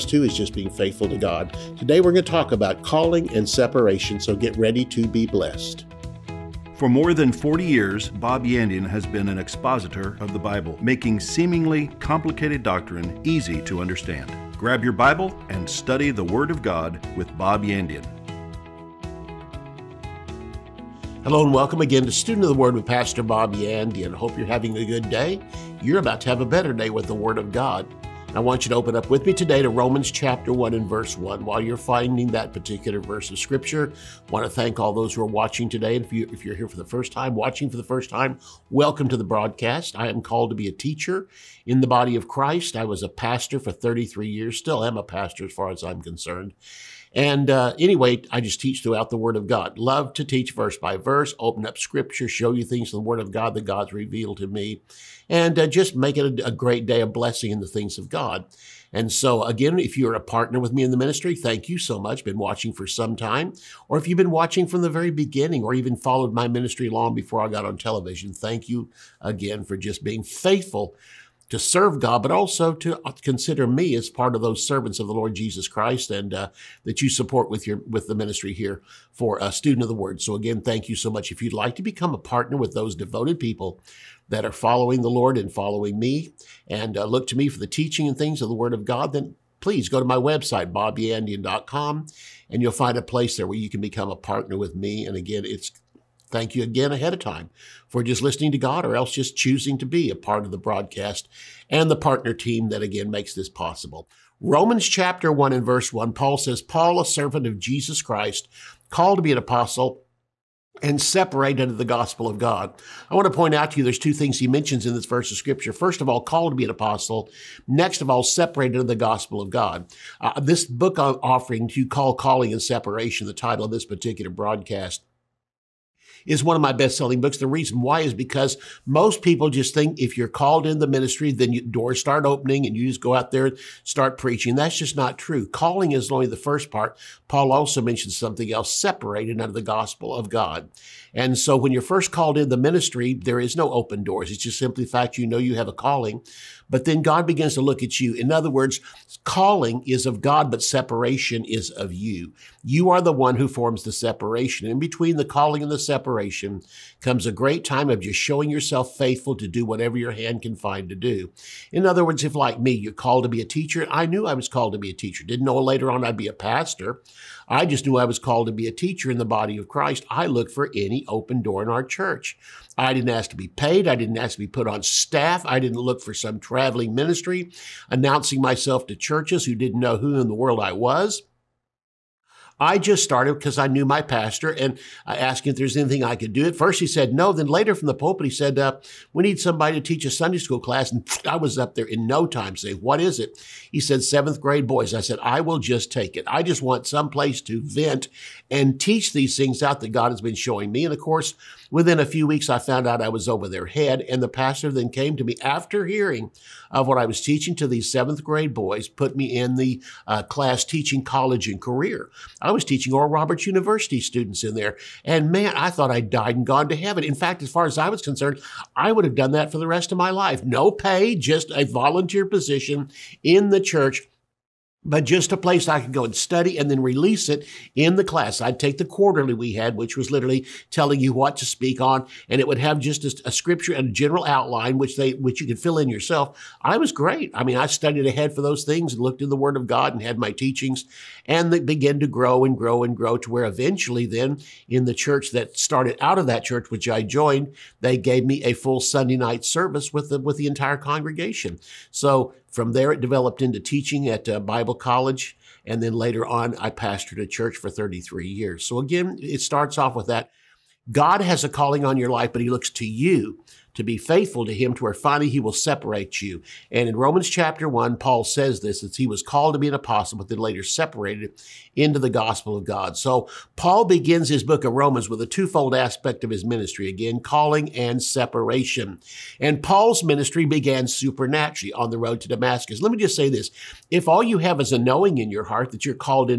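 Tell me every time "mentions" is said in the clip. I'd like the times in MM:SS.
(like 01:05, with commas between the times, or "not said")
01:54, 02:17.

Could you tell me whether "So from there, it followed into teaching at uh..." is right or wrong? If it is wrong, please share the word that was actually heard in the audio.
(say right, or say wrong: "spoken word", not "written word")
wrong: "developed", not "followed".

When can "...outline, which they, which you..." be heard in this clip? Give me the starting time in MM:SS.
03:54.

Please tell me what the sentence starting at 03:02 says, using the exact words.
I just started because I knew my pastor and I asked him if there's anything I could do.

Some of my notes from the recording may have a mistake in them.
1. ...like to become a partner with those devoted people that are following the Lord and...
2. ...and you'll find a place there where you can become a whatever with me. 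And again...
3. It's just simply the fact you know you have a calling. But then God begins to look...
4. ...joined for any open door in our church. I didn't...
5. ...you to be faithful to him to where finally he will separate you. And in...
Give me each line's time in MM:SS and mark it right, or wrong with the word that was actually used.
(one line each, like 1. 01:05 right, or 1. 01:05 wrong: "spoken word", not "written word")
1. 01:21 right
2. 01:32 wrong: "partner", not "whatever"
3. 02:24 right
4. 02:50 wrong: "looked", not "joined"
5. 04:22 right.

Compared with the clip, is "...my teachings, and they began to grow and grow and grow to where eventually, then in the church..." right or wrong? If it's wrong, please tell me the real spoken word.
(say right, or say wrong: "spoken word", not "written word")
right.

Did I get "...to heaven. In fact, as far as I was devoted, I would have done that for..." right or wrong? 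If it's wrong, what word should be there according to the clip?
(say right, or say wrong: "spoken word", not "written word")
wrong: "concerned", not "devoted".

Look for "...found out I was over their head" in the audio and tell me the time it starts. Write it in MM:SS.
03:22.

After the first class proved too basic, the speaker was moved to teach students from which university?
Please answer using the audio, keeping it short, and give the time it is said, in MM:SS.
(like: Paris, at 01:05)
Oral Roberts University, at 03:32.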